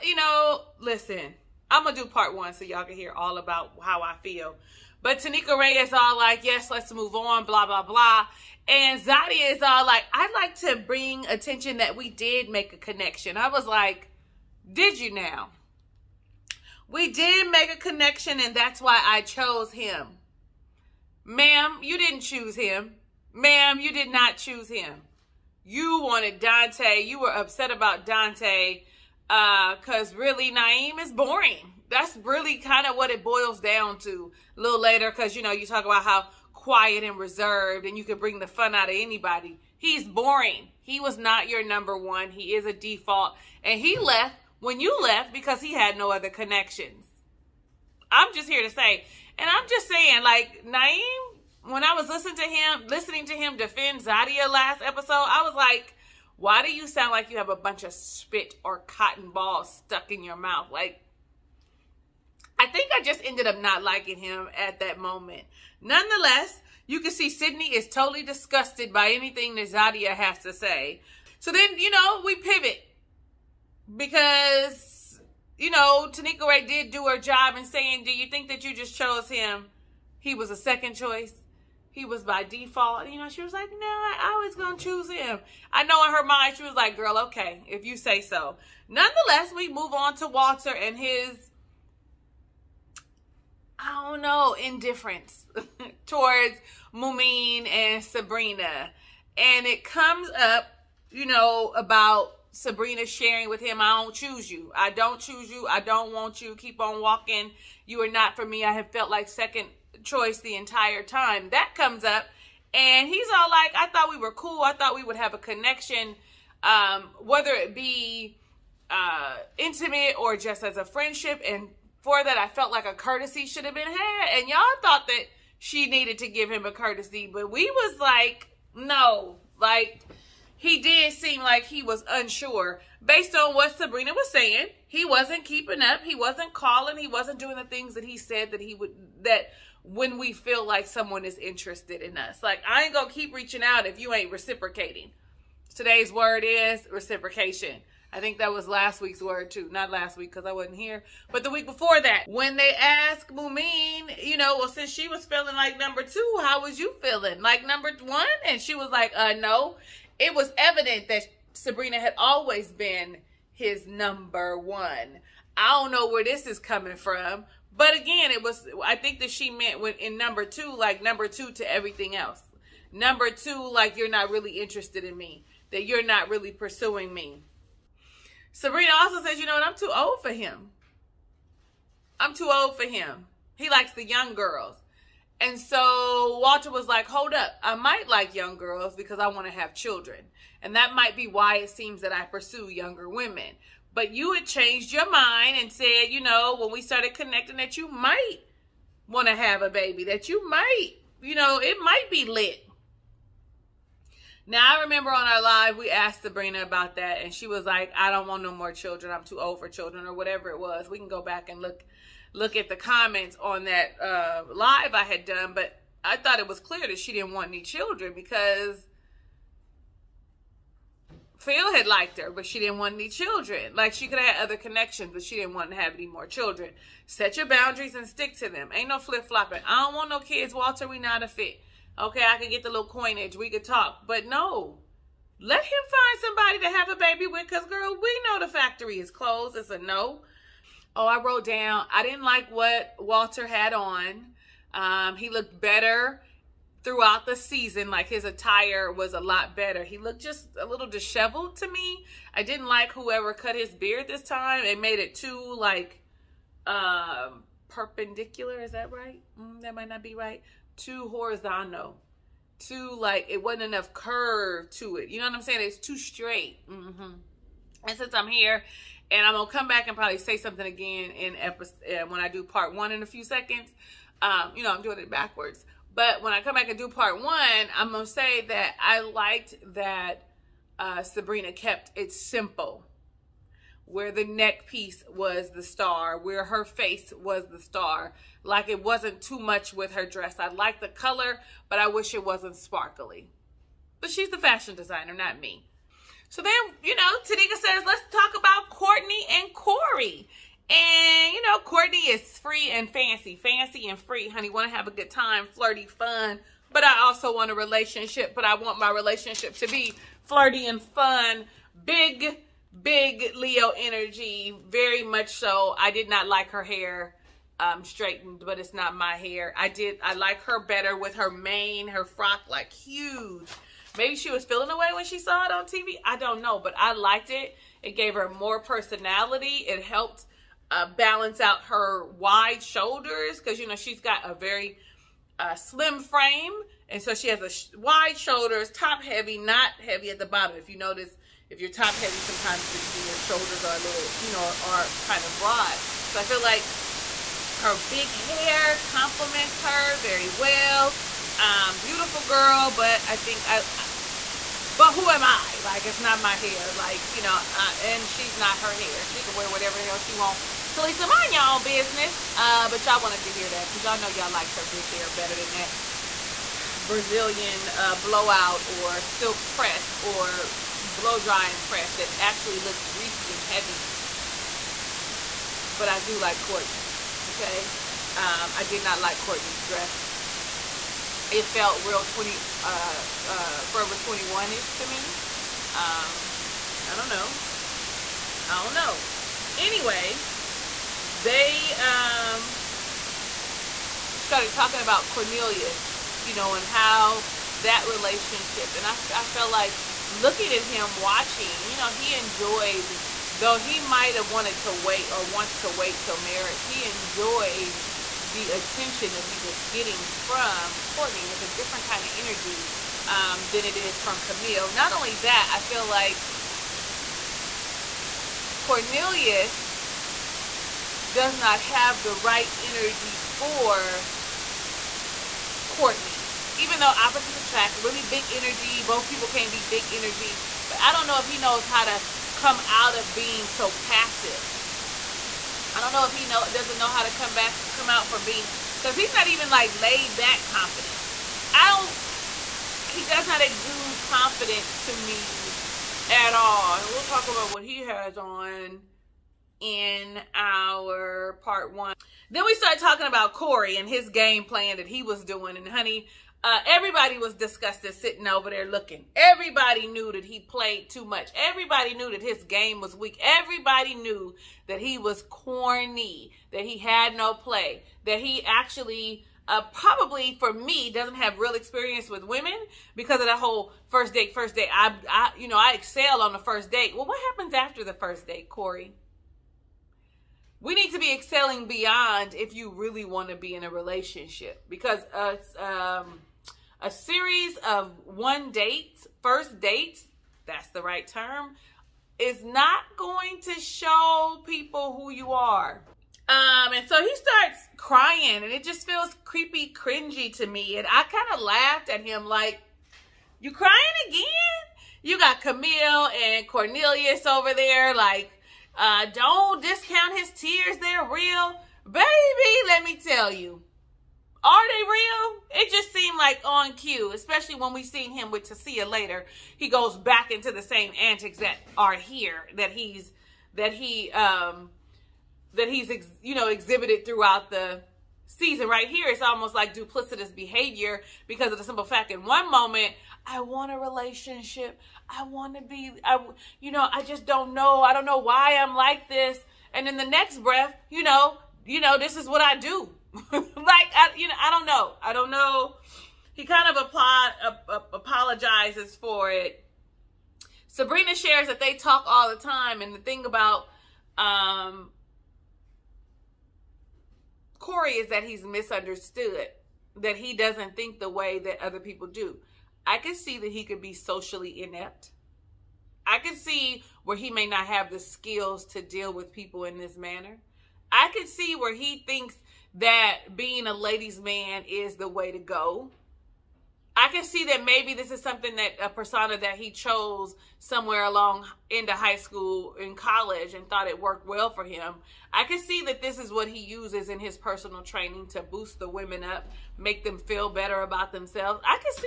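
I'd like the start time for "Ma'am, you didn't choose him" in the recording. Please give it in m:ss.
0:21.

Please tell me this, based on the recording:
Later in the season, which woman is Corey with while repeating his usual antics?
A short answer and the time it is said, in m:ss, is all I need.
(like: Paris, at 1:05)
Tasia, at 8:38.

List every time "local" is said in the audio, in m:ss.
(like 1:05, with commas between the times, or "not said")
not said.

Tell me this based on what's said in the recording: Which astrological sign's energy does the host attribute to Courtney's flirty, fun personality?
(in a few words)
Leo.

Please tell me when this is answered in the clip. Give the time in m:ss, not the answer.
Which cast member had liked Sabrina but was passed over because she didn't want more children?
3:41.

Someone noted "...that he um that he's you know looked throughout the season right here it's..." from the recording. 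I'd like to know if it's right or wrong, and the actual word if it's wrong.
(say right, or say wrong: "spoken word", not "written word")
wrong: "exhibited", not "looked".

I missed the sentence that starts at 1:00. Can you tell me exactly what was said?
Like, I think I just ended up not liking him at that moment.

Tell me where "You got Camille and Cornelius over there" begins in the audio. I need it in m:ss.
8:25.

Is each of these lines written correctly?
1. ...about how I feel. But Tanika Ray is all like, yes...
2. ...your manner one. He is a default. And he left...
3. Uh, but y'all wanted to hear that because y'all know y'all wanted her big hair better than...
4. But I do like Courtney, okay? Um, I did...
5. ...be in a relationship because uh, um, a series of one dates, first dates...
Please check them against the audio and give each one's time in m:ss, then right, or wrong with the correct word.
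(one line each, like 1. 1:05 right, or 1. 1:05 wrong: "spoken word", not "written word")
1. 0:03 right
2. 0:41 wrong: "number", not "manner"
3. 6:02 wrong: "liked", not "wanted"
4. 6:15 right
5. 8:03 right.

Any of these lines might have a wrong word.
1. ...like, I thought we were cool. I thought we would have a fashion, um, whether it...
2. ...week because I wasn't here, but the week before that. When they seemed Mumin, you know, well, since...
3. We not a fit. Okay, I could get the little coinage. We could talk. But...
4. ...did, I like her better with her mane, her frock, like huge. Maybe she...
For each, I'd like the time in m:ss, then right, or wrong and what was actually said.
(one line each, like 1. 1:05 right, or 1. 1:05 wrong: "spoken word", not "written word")
1. 1:53 wrong: "connection", not "fashion"
2. 2:30 wrong: "asked", not "seemed"
3. 3:50 right
4. 5:19 right.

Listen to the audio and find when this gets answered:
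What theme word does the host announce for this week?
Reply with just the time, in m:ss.
2:26.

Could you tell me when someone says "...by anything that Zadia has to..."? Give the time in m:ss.
1:08.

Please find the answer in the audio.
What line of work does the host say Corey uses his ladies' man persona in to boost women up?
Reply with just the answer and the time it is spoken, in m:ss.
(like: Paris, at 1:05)
personal training, at 9:47.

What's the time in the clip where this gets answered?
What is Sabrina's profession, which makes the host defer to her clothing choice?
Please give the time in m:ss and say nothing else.
4:54.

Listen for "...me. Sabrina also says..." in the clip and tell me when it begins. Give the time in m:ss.
2:57.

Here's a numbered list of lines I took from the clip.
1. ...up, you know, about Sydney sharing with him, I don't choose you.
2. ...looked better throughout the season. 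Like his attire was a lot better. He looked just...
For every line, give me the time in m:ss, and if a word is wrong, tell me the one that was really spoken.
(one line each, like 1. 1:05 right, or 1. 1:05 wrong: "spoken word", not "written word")
1. 1:40 wrong: "Sabrina", not "Sydney"
2. 4:05 right.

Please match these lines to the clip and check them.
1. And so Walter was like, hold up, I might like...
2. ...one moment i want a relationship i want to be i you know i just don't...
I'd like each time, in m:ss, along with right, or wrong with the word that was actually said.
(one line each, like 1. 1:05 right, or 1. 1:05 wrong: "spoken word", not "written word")
1. 3:05 right
2. 8:52 right.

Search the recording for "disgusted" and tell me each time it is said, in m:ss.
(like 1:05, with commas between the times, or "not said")
1:08, 7:37.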